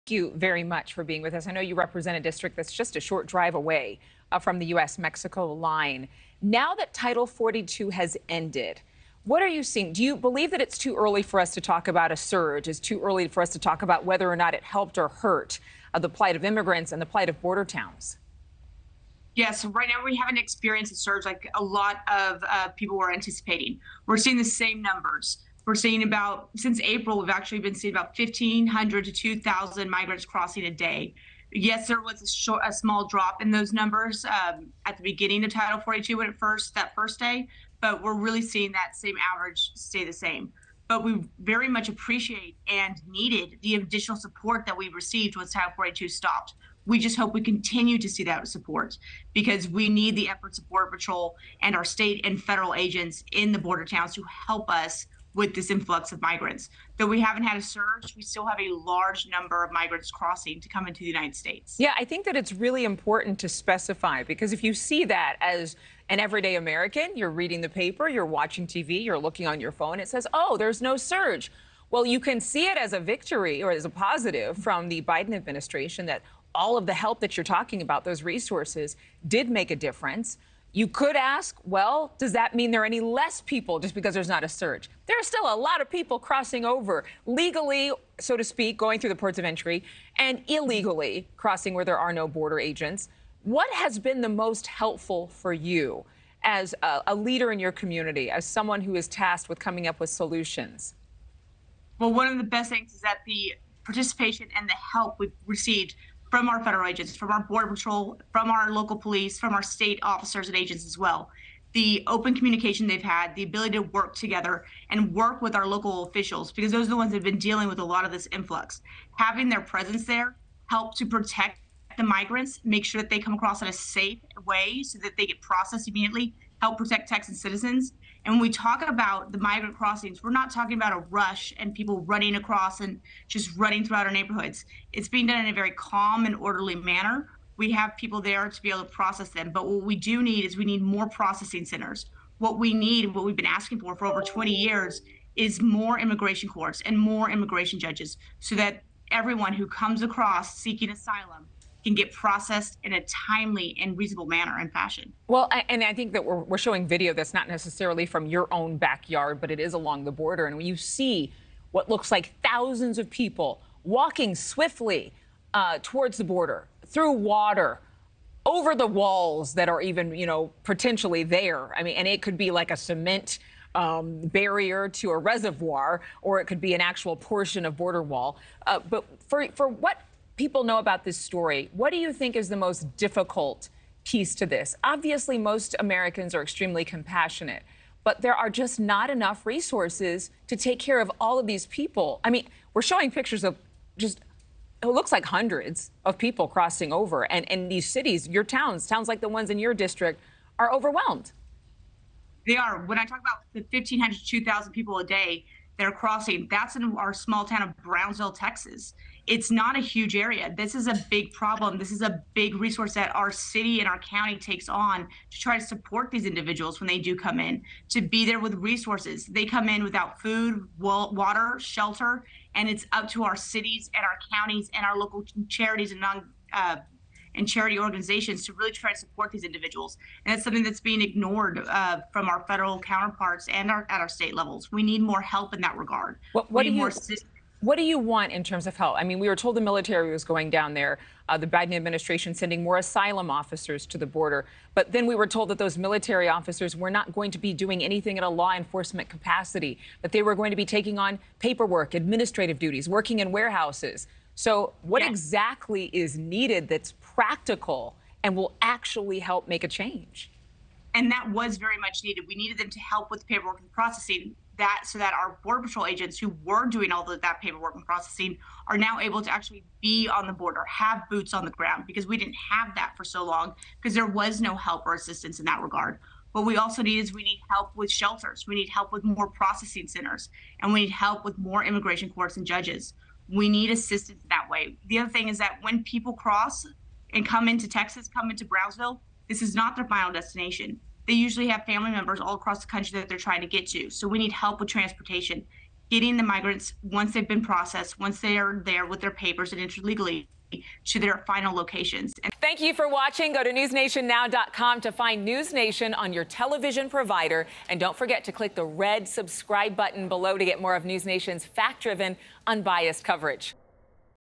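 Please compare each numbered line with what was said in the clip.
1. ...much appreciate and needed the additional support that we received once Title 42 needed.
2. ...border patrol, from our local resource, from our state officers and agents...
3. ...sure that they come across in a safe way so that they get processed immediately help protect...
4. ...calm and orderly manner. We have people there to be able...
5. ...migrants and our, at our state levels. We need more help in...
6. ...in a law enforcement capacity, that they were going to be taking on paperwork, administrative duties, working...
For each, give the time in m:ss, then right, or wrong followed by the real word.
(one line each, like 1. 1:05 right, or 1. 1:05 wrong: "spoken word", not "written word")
1. 0:41 wrong: "stopped", not "needed"
2. 1:47 wrong: "police", not "resource"
3. 2:02 right
4. 2:15 right
5. 3:52 wrong: "counterparts", not "migrants"
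6. 4:08 right.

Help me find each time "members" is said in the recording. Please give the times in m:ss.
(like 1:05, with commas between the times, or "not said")
4:51.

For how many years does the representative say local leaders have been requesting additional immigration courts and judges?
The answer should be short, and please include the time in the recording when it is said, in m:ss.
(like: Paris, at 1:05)
20 years, at 2:24.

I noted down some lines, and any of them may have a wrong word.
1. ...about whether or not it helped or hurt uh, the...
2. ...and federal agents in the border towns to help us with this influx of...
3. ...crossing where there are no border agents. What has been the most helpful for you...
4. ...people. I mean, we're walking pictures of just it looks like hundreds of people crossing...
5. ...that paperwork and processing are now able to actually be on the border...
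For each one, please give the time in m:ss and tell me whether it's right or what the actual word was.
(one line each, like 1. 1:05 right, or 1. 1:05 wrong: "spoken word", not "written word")
1. 0:13 right
2. 0:52 right
3. 1:31 right
4. 3:11 wrong: "showing", not "walking"
5. 4:27 right.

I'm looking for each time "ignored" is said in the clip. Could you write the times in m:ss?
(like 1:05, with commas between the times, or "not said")
3:51.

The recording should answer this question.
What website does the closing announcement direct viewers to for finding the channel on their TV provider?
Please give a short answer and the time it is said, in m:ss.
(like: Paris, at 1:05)
newsnationnow.com, at 5:03.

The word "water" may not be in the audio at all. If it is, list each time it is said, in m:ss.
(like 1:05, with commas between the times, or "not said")
2:47, 3:40.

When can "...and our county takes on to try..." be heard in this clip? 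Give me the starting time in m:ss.
3:33.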